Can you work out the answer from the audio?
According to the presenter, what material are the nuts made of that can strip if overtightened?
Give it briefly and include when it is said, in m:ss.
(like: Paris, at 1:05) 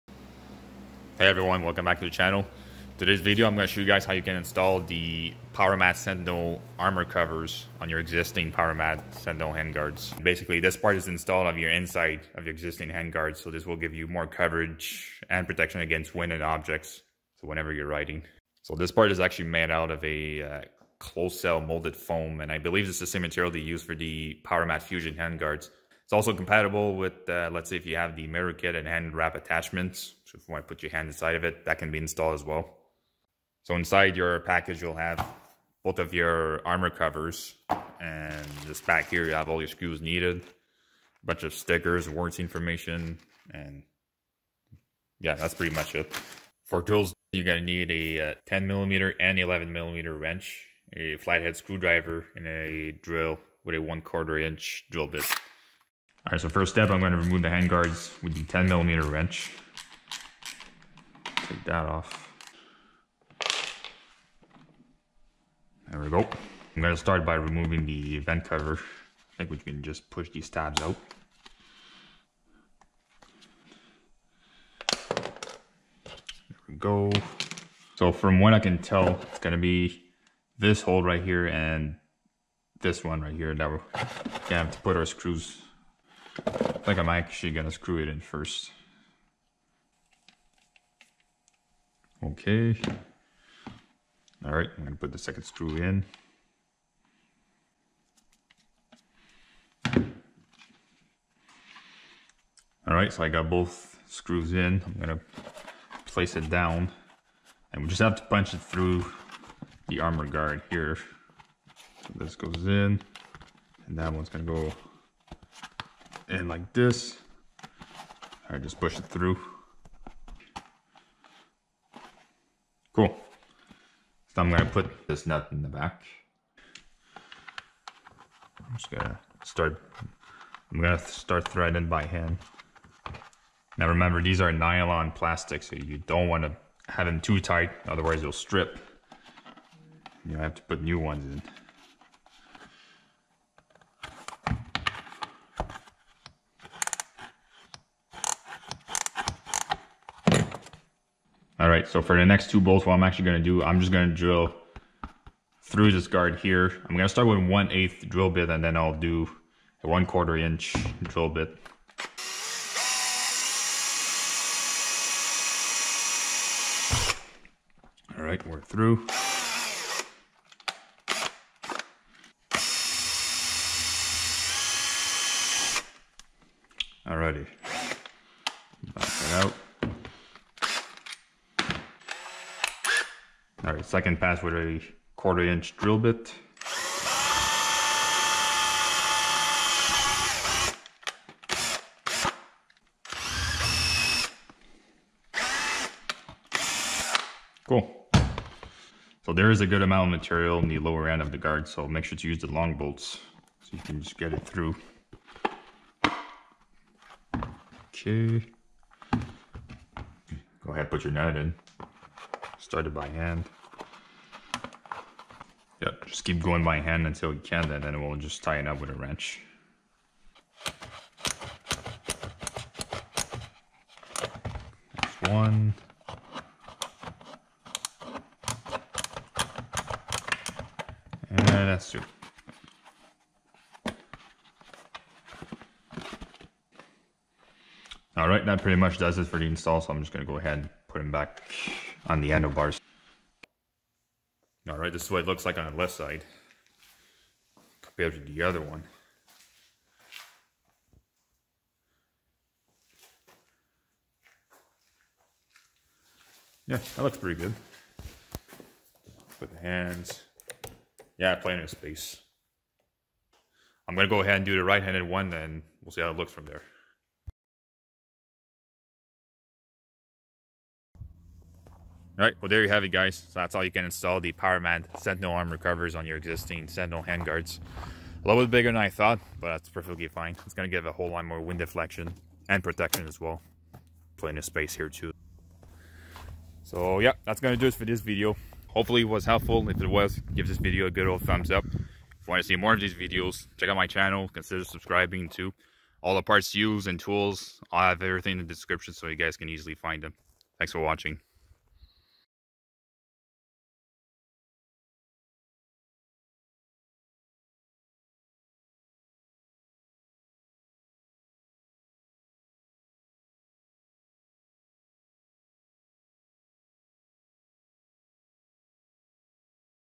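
nylon plastic, at 2:14.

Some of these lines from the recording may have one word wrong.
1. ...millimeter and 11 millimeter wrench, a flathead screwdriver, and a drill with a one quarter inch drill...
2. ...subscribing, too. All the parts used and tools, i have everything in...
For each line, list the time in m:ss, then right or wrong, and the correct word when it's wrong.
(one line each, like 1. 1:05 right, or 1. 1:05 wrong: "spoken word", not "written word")
1. 0:48 right
2. 4:54 right.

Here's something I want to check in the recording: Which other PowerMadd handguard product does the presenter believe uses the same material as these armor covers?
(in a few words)
PowerMadd Fusion.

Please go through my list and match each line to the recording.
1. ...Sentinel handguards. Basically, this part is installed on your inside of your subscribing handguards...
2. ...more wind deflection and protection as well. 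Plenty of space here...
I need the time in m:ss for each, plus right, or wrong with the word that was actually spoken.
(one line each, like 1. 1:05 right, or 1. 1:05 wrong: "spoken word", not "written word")
1. 0:09 wrong: "existing", not "subscribing"
2. 4:41 right.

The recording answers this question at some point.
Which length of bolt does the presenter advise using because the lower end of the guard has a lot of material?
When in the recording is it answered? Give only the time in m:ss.
3:22.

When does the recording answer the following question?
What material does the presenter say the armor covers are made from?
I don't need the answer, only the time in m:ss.
0:20.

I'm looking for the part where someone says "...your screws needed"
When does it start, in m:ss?
0:39.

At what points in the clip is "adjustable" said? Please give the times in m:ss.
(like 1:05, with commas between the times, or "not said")
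not said.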